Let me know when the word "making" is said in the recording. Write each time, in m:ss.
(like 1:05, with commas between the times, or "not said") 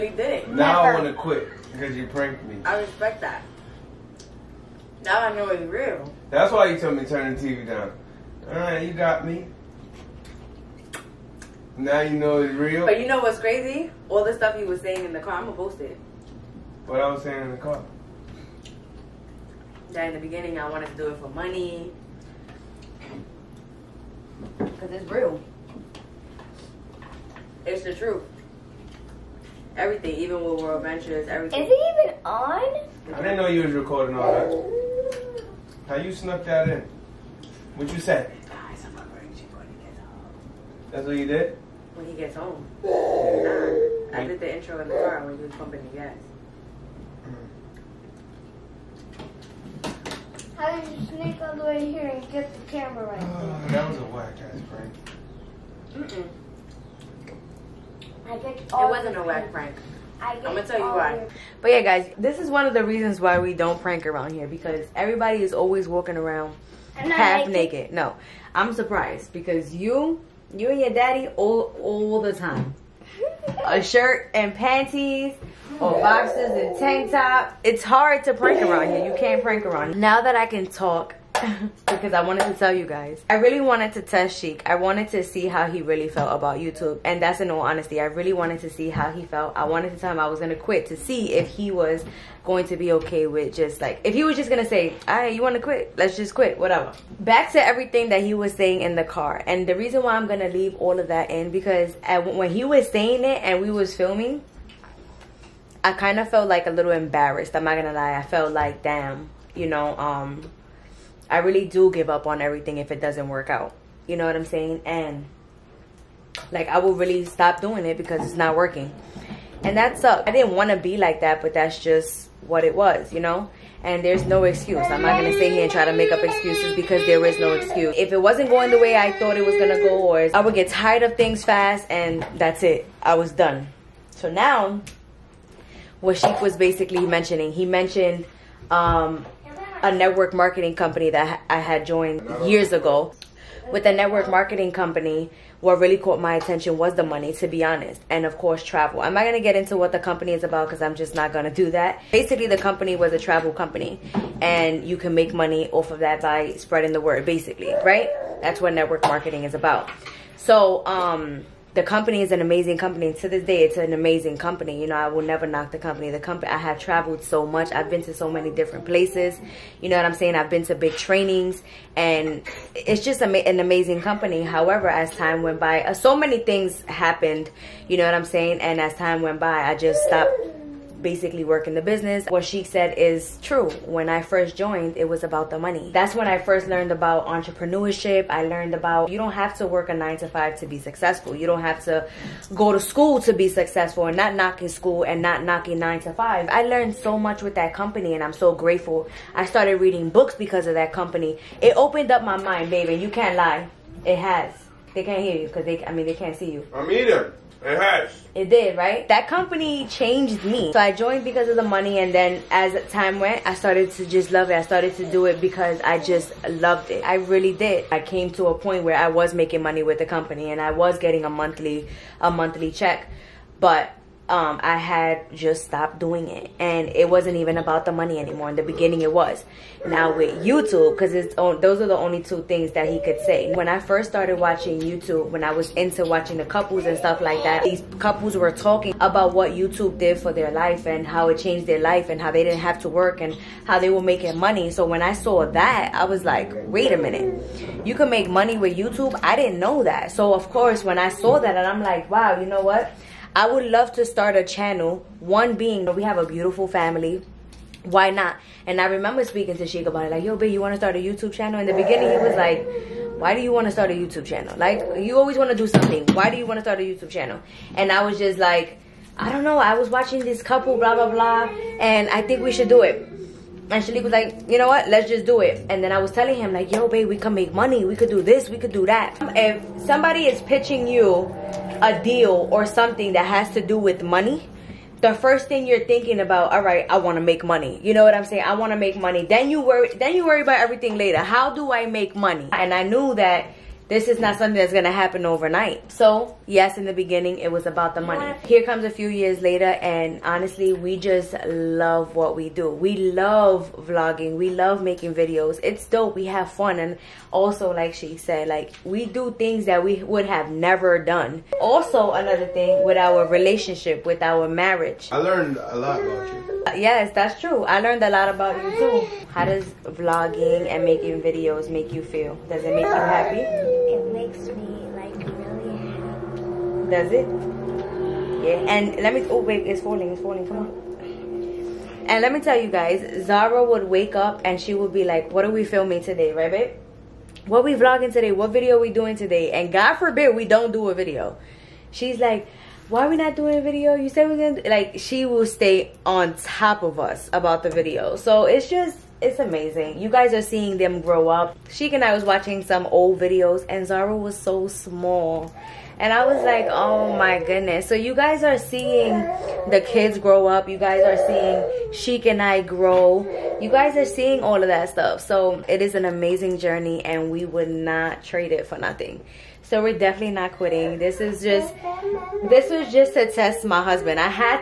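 3:39, 4:04, 5:04, 5:20.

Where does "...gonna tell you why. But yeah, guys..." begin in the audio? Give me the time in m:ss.
1:00.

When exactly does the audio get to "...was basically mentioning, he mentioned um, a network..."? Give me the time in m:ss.
2:16.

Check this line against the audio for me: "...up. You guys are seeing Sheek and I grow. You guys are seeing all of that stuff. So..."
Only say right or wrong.
right.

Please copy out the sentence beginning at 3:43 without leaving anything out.
But um, I had just stopped doing it.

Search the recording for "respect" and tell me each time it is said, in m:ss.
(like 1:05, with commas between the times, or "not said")
0:02.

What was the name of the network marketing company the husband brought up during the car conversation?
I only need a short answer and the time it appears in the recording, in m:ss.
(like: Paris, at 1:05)
World Ventures, at 0:30.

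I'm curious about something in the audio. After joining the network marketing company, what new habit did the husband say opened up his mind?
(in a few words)
reading books.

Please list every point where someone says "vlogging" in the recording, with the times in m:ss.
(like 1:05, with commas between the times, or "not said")
5:03, 5:19, 5:37.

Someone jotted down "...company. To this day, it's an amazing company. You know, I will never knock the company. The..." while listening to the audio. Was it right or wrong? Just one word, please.
right.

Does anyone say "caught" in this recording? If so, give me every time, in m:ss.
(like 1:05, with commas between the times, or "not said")
2:25.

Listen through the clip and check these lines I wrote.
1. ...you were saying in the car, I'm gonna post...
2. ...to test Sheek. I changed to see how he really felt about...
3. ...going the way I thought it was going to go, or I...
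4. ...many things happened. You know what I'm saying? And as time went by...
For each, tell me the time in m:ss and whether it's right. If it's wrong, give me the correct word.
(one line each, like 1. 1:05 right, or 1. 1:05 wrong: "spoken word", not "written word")
1. 0:14 right
2. 1:23 wrong: "wanted", not "changed"
3. 2:08 right
4. 2:56 right.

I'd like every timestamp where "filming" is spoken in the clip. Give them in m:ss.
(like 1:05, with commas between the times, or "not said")
1:43, 5:35.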